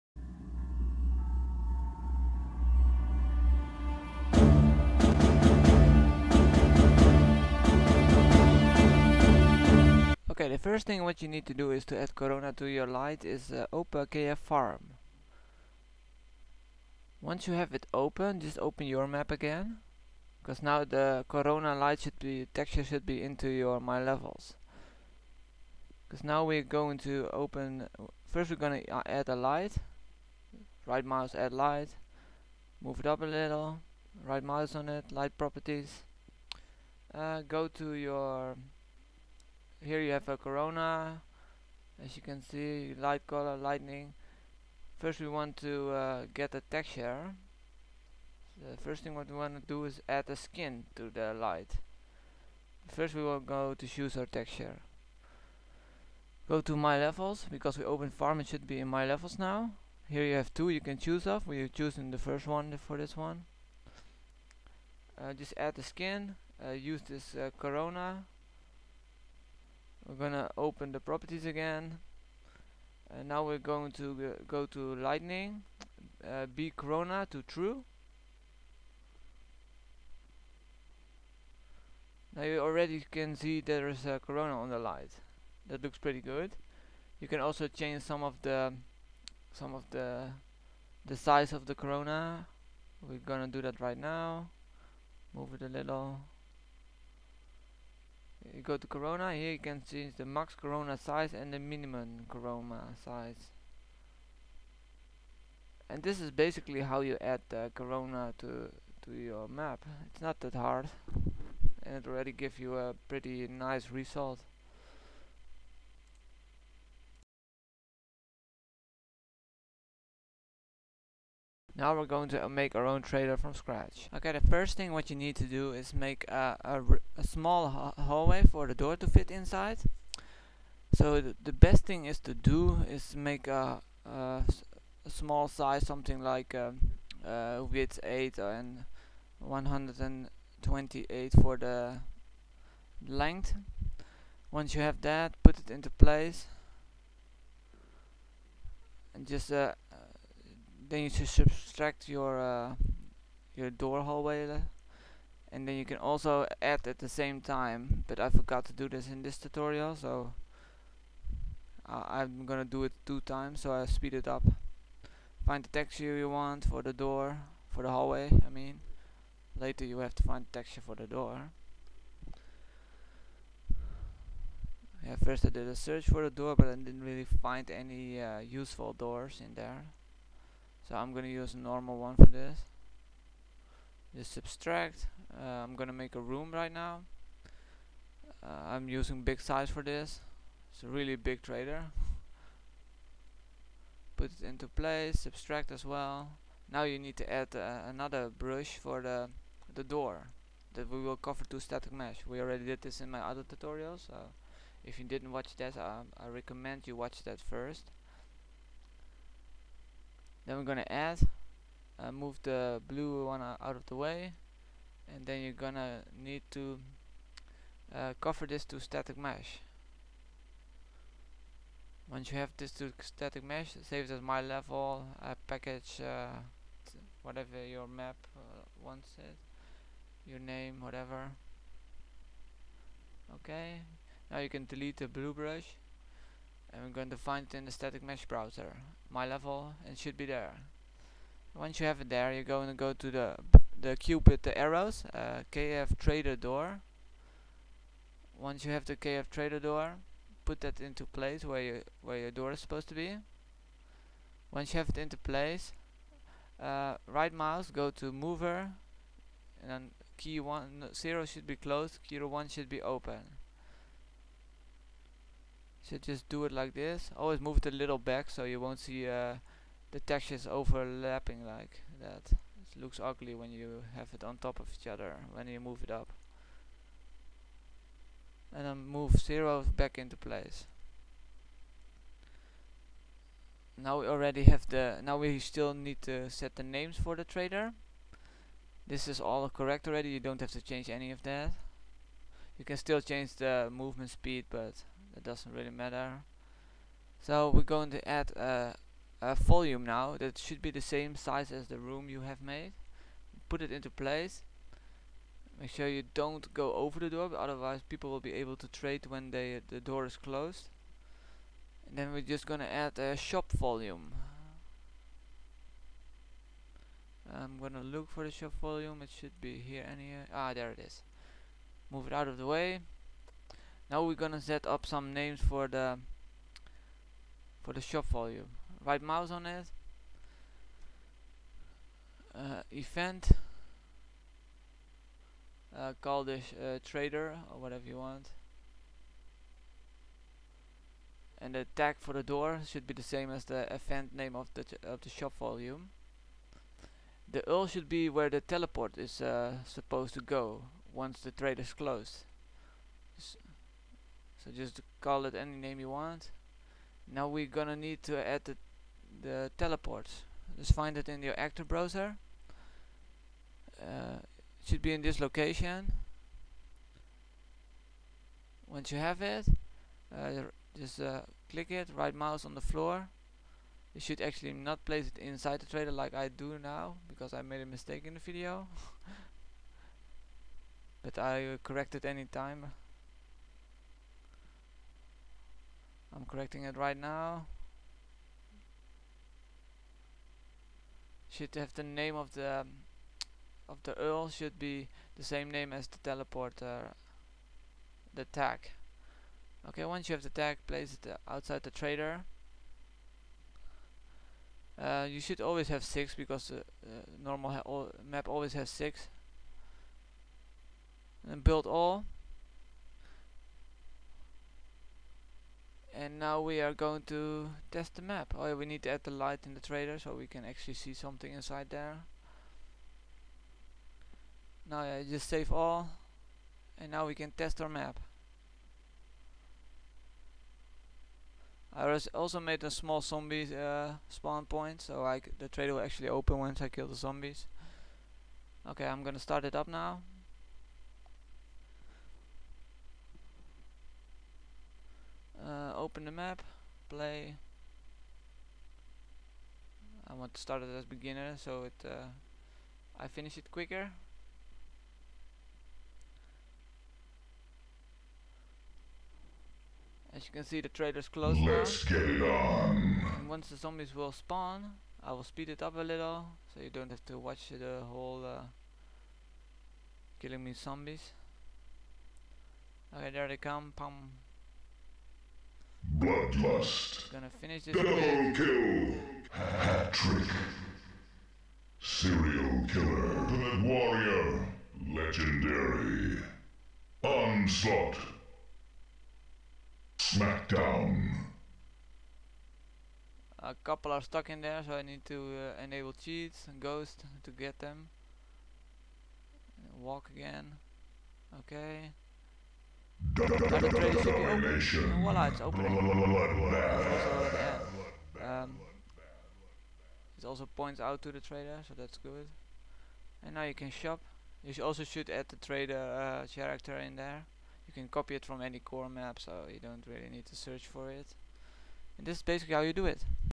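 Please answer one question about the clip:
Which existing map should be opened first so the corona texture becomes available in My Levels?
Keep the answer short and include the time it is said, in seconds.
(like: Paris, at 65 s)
KF Farm, at 14 s.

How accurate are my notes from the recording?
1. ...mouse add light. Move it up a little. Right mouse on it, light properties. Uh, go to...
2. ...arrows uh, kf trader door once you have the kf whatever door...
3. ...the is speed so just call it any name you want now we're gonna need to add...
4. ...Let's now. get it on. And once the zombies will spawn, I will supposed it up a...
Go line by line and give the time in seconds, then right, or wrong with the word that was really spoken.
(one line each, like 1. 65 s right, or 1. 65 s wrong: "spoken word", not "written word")
1. 31 s right
2. 244 s wrong: "trader", not "whatever"
3. 351 s wrong: "closed", not "speed"
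4. 461 s wrong: "speed", not "supposed".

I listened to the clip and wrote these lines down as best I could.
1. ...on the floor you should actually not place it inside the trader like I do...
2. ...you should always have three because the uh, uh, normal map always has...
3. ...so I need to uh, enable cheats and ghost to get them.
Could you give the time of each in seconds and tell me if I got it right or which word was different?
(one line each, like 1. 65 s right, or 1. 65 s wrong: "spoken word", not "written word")
1. 372 s right
2. 405 s wrong: "six", not "three"
3. 494 s right.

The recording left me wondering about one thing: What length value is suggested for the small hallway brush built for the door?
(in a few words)
128.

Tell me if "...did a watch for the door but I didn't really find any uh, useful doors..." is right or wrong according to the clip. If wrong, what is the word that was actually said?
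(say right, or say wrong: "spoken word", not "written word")
wrong: "search", not "watch".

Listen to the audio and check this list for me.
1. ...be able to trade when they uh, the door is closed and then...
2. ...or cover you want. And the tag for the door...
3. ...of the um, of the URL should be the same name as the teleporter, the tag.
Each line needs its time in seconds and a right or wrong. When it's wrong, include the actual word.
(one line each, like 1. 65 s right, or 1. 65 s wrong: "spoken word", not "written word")
1. 308 s right
2. 337 s wrong: "whatever", not "cover"
3. 392 s right.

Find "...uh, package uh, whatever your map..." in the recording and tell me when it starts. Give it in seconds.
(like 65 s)
225 s.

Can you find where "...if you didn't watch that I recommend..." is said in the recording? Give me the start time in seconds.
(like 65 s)
204 s.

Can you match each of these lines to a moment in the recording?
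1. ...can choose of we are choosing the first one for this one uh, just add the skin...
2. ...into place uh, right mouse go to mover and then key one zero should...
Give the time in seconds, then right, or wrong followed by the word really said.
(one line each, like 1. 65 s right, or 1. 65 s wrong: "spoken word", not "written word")
1. 60 s right
2. 254 s right.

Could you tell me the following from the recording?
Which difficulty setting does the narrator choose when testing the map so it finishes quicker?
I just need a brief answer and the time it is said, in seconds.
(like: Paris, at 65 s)
Beginner, at 450 s.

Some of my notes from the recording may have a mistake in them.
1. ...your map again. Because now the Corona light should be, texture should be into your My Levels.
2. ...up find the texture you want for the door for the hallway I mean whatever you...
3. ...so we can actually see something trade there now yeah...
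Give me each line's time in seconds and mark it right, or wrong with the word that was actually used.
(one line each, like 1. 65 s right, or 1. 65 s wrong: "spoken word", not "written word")
1. 18 s right
2. 164 s wrong: "later", not "whatever"
3. 419 s wrong: "inside", not "trade".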